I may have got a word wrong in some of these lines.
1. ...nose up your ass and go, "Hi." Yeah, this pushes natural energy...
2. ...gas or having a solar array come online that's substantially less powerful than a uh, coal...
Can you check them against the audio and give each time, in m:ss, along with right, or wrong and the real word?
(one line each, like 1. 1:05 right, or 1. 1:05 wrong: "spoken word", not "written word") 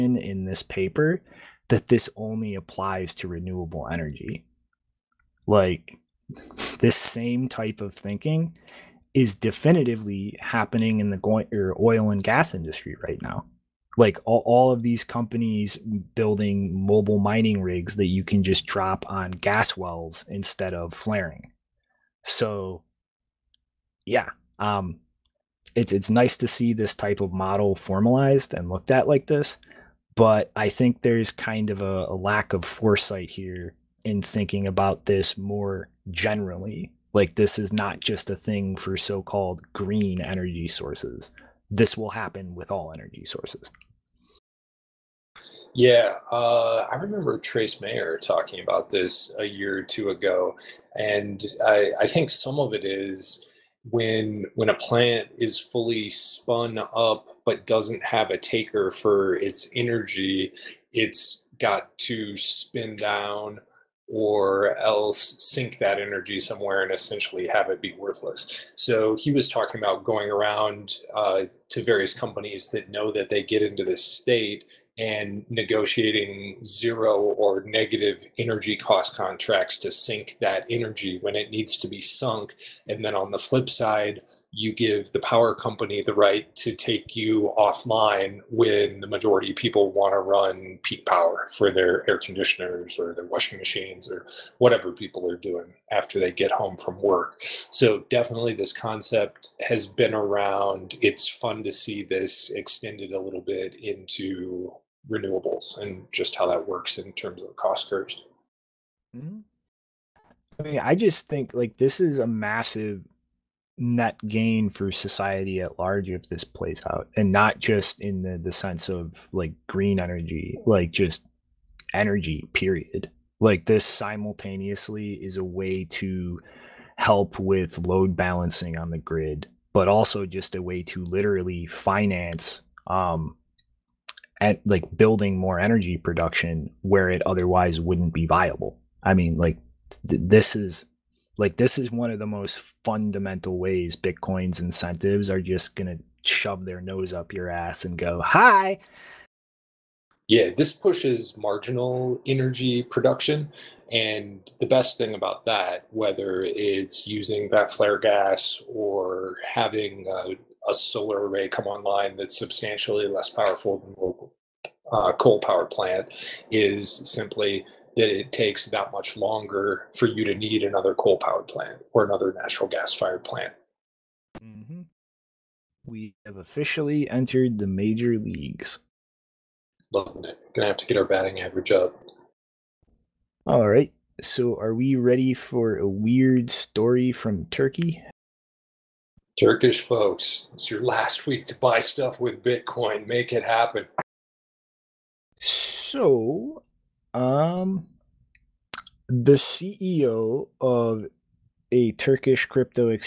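1. 2:26 wrong: "marginal", not "natural"
2. 2:37 right.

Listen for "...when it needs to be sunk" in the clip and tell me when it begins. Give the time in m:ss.
1:21.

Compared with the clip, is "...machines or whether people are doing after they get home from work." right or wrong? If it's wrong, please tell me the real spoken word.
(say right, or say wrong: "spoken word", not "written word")
wrong: "whatever", not "whether".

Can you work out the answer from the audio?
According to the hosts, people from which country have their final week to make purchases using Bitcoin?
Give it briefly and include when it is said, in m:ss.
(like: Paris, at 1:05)
Turkey, at 3:07.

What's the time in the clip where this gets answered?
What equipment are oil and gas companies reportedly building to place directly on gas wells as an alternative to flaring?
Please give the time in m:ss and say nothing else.
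0:16.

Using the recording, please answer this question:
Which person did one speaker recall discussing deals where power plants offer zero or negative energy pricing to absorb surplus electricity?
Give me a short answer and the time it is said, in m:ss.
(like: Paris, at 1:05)
Trace Mayer, at 0:47.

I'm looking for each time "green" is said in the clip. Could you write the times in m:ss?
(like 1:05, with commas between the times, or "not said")
0:39, 1:59.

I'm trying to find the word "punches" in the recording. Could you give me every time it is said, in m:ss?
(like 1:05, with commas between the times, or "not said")
not said.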